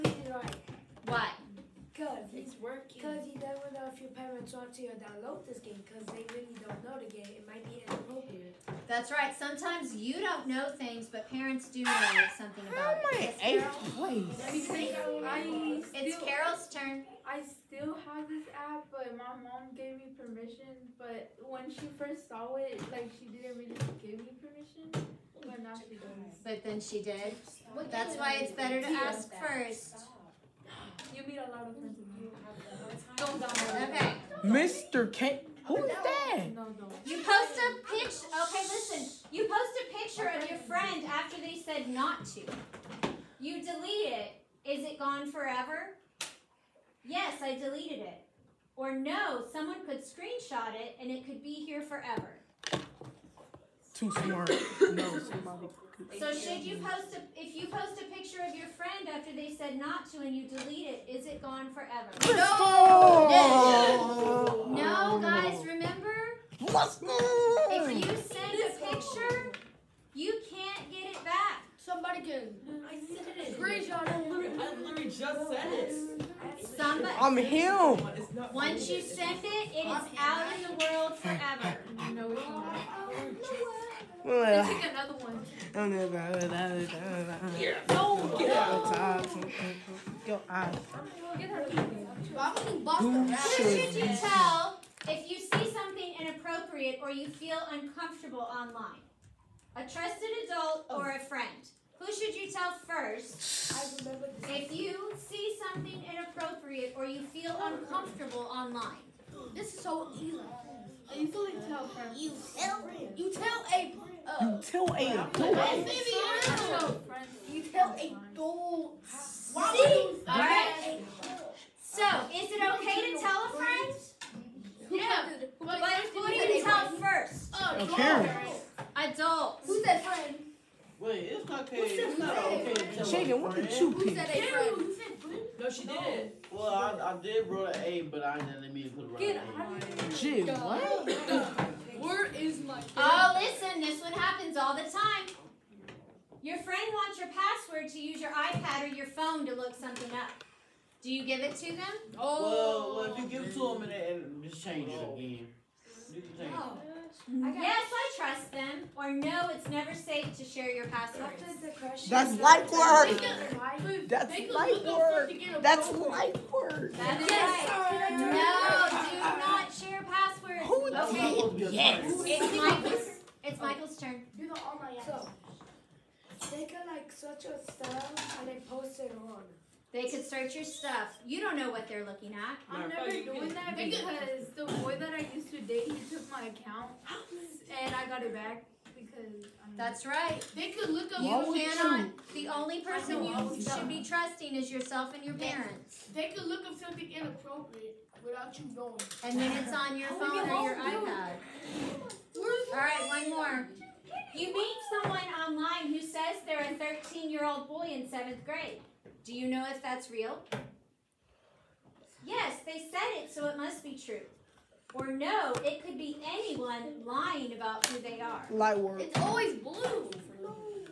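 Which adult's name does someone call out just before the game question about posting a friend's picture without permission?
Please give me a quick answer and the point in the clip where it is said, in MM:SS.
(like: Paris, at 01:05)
Mr. Kent, at 00:34.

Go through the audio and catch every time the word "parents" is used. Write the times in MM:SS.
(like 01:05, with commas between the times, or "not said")
00:04, 00:11, 03:15.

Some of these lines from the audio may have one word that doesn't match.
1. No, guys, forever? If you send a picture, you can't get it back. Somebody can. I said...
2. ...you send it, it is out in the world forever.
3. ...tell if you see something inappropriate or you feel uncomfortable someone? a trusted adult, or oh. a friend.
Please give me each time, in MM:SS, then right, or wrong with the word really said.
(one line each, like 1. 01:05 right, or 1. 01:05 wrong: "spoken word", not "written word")
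1. 01:04 wrong: "remember", not "forever"
2. 01:18 right
3. 01:34 wrong: "online", not "someone".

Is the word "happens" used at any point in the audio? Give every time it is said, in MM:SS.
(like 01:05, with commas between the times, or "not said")
02:24.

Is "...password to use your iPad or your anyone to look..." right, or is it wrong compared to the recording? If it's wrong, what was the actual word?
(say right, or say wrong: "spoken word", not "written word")
wrong: "phone", not "anyone".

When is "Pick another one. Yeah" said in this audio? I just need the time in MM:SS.
01:24.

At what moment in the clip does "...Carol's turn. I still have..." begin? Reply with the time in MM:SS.
00:16.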